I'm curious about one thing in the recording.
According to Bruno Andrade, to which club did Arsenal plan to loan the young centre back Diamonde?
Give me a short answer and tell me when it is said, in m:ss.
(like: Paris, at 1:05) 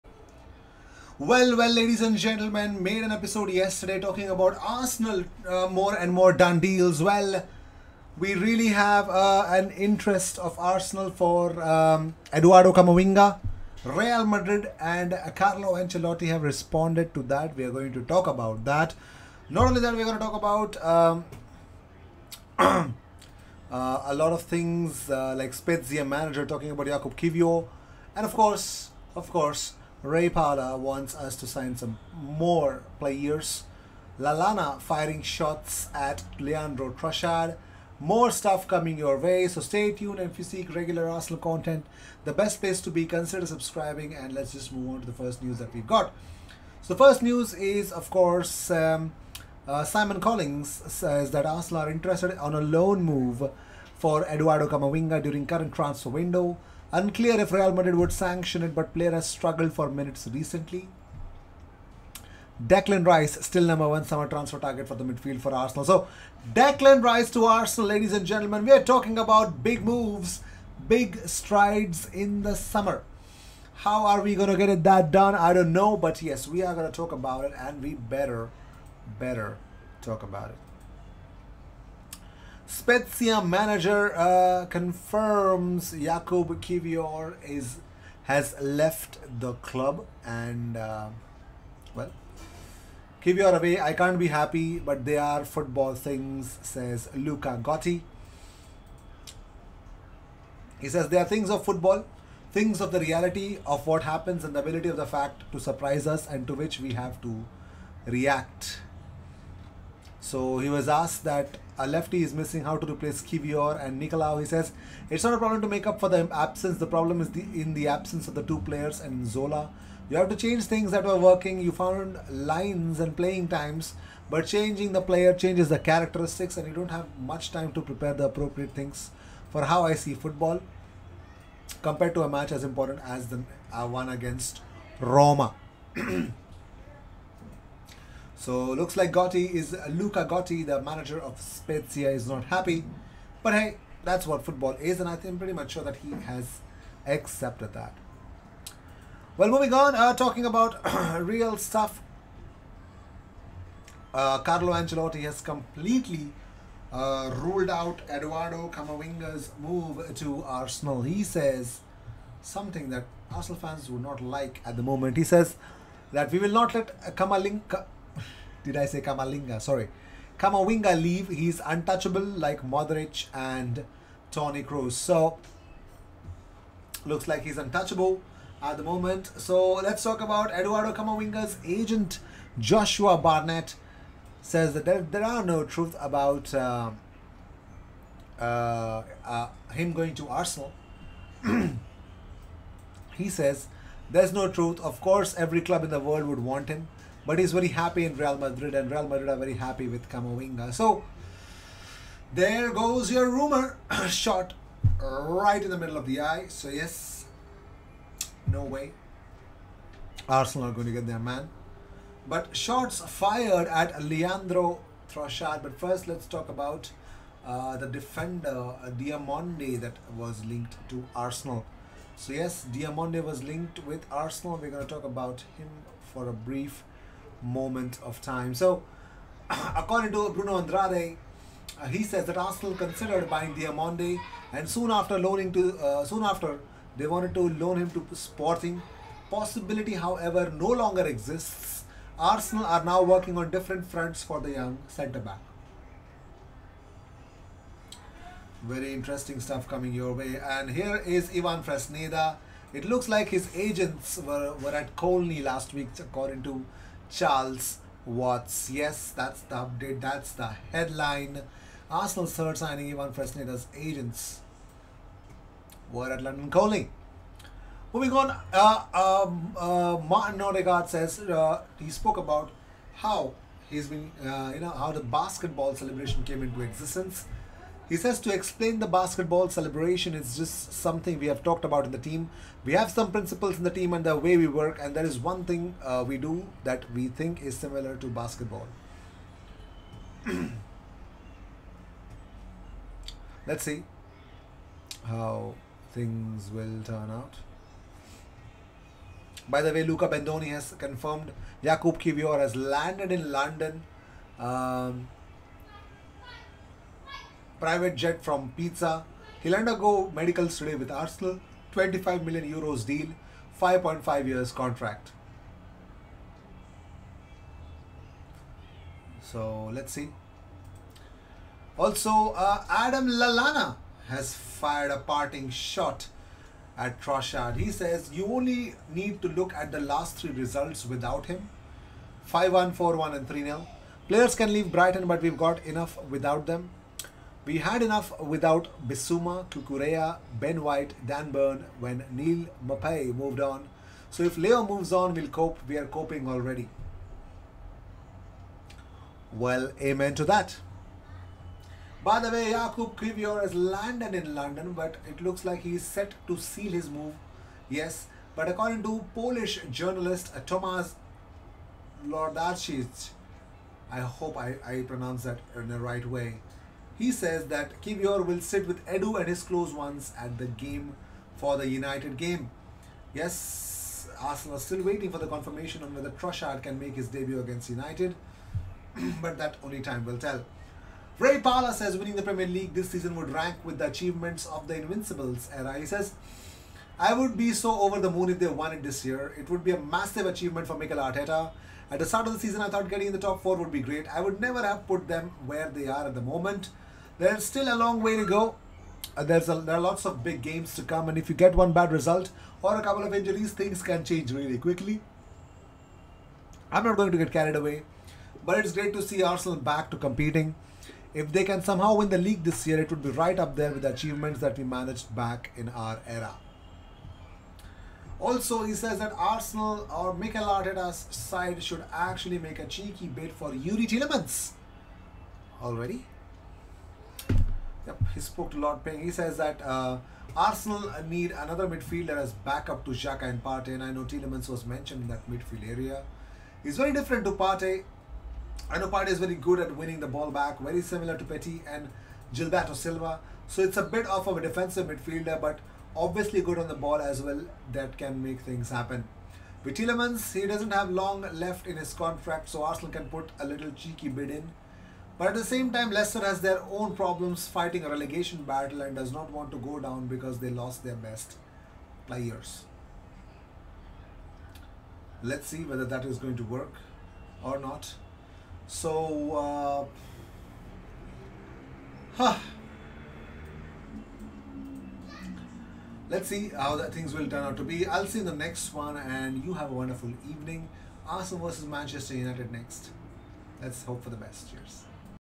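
Sporting, at 3:58.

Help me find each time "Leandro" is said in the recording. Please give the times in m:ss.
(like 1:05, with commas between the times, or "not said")
0:36, 3:34.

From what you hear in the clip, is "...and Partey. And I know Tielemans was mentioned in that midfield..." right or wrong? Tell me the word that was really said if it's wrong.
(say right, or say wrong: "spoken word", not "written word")
right.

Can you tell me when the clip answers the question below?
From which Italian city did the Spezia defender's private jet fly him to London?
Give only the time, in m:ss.
5:08.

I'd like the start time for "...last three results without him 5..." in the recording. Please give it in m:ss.
5:29.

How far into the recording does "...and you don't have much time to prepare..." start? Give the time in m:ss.
2:06.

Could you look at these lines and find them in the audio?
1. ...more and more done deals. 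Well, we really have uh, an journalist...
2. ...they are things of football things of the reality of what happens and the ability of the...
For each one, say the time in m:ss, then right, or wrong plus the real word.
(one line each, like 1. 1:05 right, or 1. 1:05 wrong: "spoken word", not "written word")
1. 0:05 wrong: "interest", not "journalist"
2. 1:41 right.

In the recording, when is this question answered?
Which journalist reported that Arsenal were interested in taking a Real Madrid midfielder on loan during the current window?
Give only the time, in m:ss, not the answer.
0:49.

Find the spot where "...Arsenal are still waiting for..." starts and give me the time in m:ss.
6:14.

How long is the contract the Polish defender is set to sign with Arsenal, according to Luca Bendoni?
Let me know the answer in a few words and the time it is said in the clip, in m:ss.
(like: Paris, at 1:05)
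5.5 years, at 5:13.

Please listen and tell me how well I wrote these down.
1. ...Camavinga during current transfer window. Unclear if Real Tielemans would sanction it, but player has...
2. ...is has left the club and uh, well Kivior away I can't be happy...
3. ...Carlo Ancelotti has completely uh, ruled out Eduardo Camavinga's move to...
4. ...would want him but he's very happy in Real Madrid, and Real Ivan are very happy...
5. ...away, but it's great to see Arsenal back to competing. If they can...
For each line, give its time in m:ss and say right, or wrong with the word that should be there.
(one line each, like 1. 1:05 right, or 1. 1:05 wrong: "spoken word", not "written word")
1. 0:54 wrong: "Madrid", not "Tielemans"
2. 1:27 right
3. 2:34 right
4. 3:16 wrong: "Madrid", not "Ivan"
5. 6:47 right.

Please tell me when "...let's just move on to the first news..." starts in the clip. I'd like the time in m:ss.
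0:44.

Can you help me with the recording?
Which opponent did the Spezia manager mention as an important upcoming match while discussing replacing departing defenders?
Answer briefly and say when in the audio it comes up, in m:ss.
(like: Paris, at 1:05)
Roma, at 2:14.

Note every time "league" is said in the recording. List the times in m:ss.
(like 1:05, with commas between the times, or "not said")
6:22, 6:52.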